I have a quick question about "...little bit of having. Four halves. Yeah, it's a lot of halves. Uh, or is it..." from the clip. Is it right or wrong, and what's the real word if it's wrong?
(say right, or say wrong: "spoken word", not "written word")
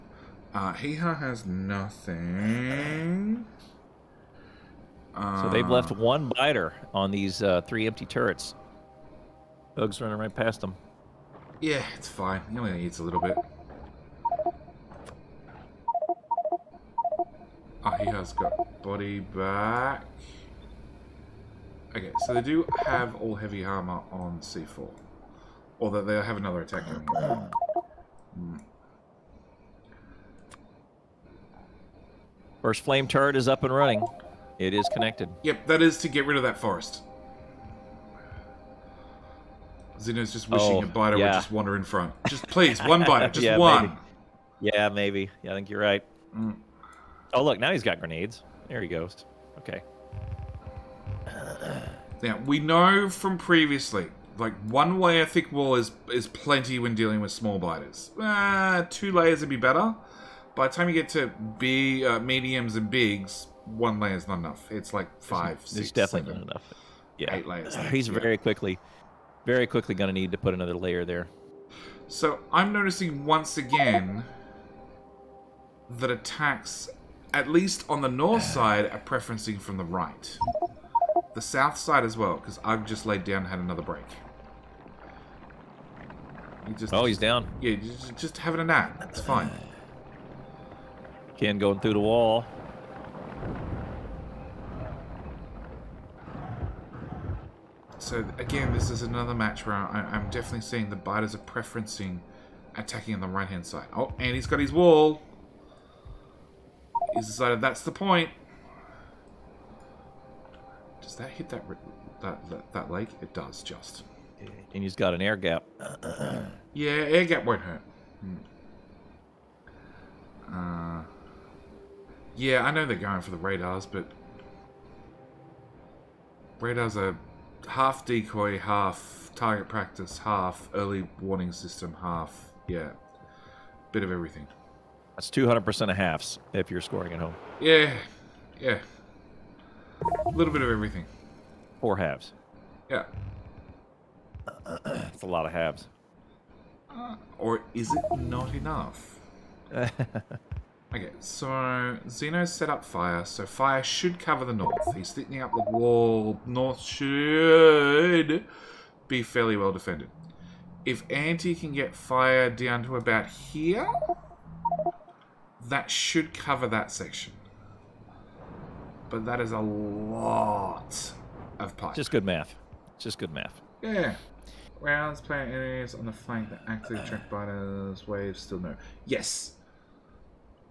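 wrong: "everything", not "having".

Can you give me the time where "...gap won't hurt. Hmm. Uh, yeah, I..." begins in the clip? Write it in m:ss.
1:57.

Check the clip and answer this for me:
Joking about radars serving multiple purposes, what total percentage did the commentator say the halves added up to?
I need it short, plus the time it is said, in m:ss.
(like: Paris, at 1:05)
200 percent, at 2:15.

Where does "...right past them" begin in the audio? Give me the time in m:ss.
0:10.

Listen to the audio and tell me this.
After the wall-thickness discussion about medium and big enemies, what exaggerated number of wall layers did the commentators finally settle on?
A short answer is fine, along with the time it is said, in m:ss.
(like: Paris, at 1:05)
8, at 1:07.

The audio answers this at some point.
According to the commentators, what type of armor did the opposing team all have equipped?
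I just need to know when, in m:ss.
0:23.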